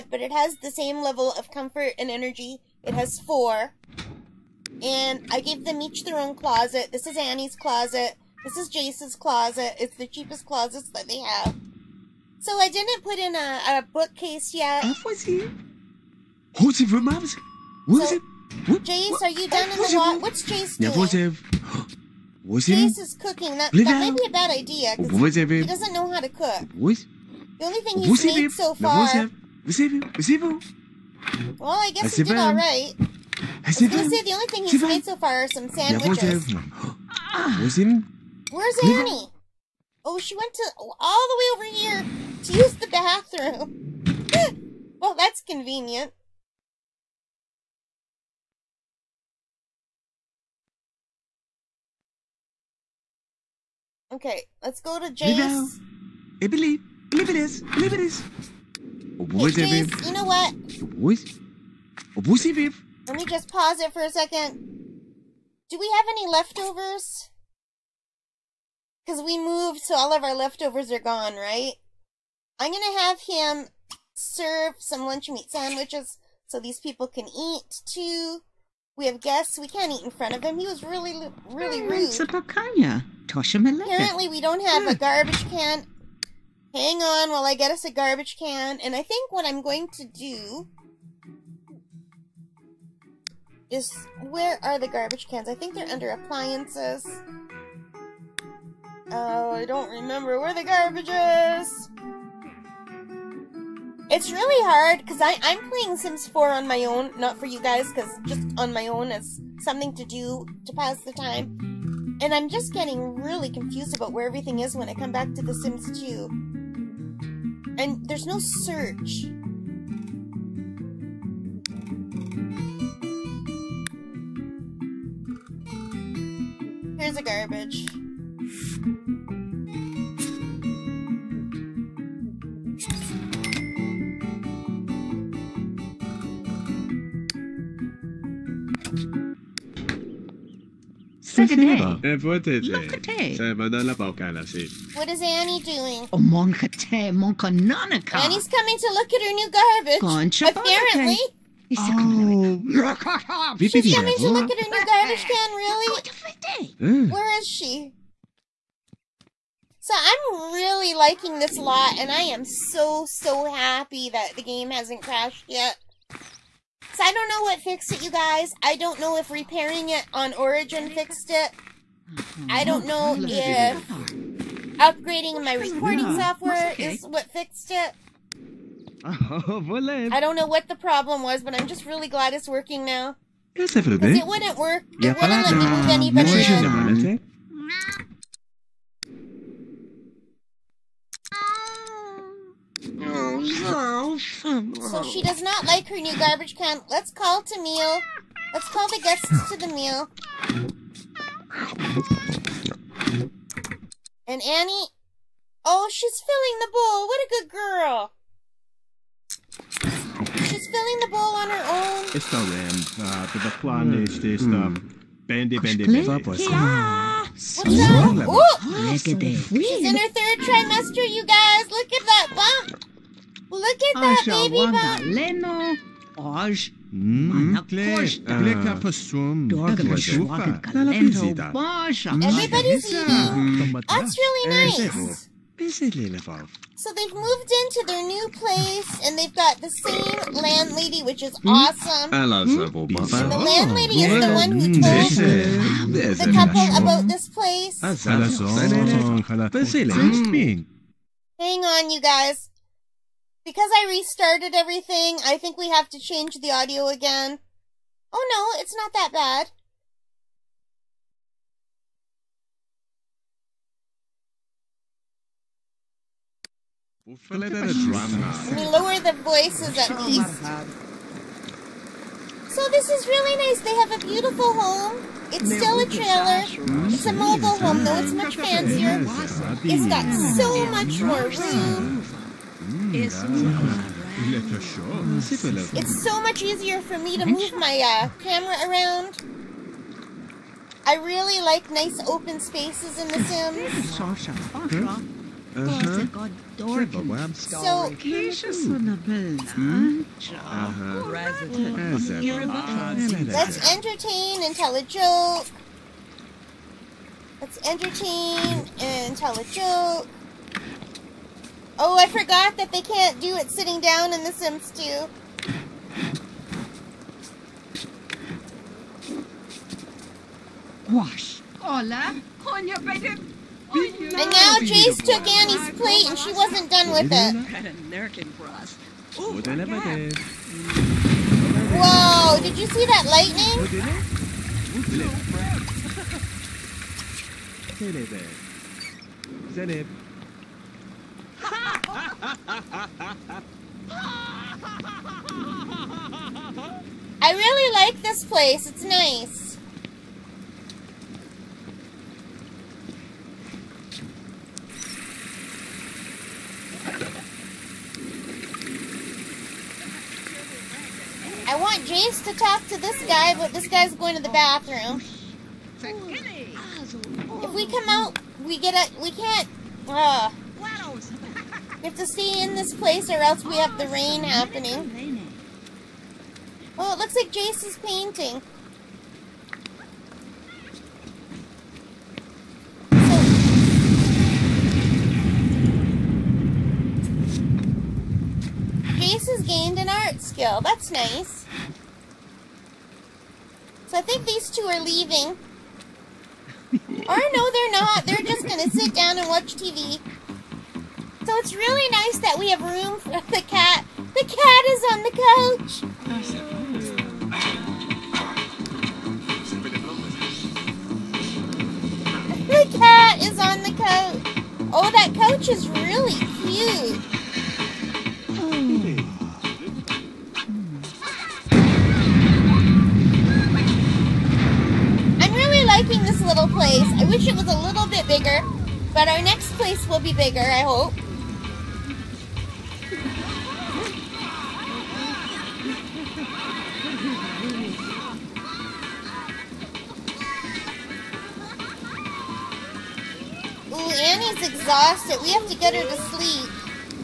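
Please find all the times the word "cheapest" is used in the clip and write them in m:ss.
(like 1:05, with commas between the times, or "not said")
0:10.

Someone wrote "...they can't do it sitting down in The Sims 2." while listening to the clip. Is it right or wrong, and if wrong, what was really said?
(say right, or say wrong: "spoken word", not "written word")
right.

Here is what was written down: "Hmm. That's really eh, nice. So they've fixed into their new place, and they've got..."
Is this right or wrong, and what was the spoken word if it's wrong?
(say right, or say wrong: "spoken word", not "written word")
wrong: "moved", not "fixed".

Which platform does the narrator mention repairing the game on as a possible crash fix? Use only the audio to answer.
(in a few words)
Origin.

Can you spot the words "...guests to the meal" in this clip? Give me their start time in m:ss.
3:19.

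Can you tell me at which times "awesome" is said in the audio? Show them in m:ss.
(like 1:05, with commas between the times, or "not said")
4:01.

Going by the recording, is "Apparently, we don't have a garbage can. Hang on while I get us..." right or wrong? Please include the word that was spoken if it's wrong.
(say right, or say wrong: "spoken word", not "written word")
right.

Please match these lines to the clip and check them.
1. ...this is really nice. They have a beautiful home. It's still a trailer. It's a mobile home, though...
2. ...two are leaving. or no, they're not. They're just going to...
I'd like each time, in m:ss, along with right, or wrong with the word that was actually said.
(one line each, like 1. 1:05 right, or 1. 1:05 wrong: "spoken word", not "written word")
1. 4:32 right
2. 6:34 right.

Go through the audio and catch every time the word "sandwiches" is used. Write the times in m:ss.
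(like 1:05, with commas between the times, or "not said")
0:35, 1:15.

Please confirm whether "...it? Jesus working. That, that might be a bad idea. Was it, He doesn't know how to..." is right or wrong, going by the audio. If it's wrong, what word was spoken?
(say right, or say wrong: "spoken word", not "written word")
wrong: "cooking", not "working".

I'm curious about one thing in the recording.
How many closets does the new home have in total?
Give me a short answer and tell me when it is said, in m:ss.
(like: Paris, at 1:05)
4, at 0:02.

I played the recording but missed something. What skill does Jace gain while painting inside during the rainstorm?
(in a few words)
Art skill.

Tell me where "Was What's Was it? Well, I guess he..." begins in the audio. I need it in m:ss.
0:29.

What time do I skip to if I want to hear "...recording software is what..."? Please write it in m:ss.
2:55.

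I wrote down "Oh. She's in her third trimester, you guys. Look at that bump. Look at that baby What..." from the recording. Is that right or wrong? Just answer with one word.
wrong.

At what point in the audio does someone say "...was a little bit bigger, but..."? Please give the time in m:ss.
7:07.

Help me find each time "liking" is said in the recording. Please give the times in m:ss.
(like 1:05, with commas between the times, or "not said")
2:40, 7:05.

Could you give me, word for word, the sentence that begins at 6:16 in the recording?
Oh, it looks like Jace is painting.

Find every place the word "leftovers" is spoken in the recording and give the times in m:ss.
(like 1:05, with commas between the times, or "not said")
1:06, 1:10.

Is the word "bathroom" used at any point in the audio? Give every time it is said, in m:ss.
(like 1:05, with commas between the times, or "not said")
0:42, 6:04.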